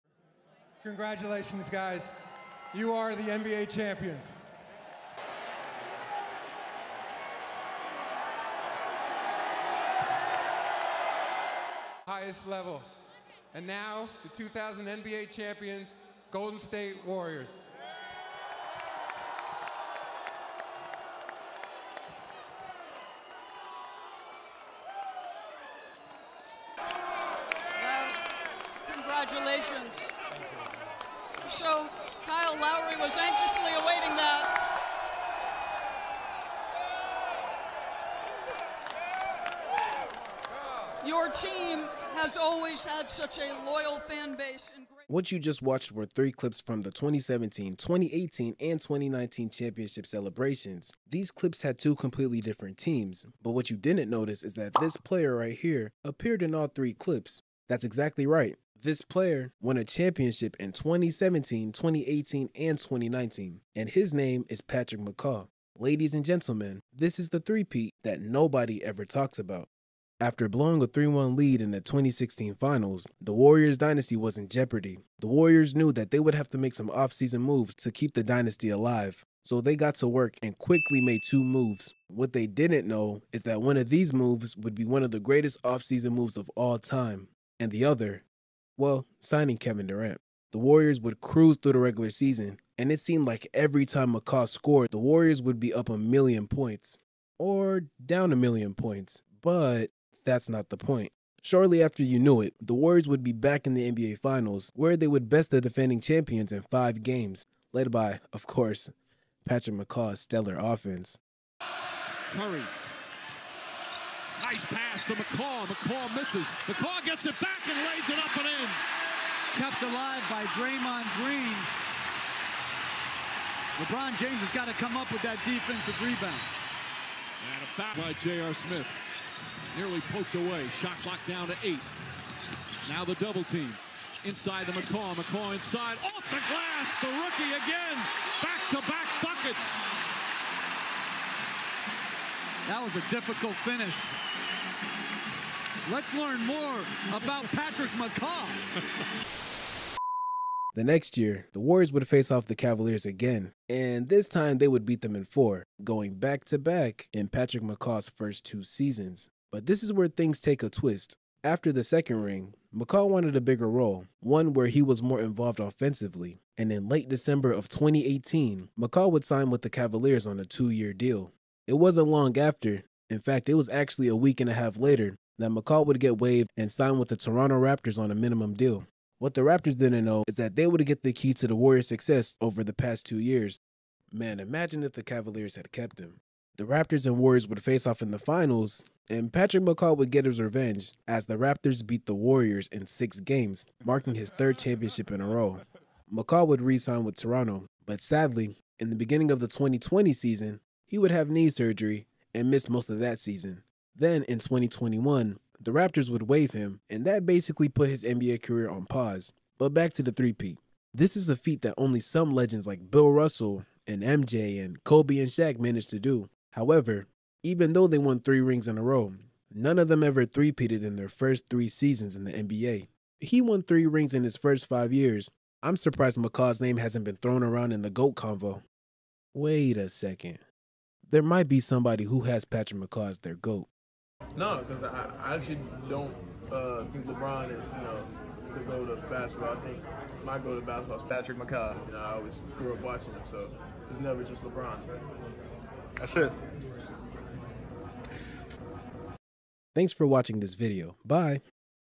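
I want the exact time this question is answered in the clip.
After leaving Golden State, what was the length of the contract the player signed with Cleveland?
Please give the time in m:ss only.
2:50.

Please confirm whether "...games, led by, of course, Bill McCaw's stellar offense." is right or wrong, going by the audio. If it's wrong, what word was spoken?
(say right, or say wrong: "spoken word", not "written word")
wrong: "Patrick", not "Bill".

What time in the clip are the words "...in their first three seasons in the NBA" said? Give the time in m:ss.
3:40.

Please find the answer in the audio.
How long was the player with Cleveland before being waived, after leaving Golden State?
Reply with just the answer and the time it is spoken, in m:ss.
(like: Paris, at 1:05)
a week and a half, at 2:54.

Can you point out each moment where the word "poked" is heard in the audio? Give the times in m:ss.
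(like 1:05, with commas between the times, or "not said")
2:10.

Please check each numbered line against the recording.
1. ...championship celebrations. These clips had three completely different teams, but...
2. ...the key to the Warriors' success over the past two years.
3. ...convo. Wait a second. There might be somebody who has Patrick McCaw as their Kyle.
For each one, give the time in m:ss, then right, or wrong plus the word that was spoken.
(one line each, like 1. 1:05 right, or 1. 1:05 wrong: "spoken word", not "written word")
1. 0:49 wrong: "two", not "three"
2. 3:01 right
3. 3:48 wrong: "GOAT", not "Kyle".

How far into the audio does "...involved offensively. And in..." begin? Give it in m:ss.
2:45.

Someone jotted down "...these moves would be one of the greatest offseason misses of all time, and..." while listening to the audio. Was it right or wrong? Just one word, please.
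wrong.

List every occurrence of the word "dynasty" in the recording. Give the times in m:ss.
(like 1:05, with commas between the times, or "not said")
1:13, 1:18.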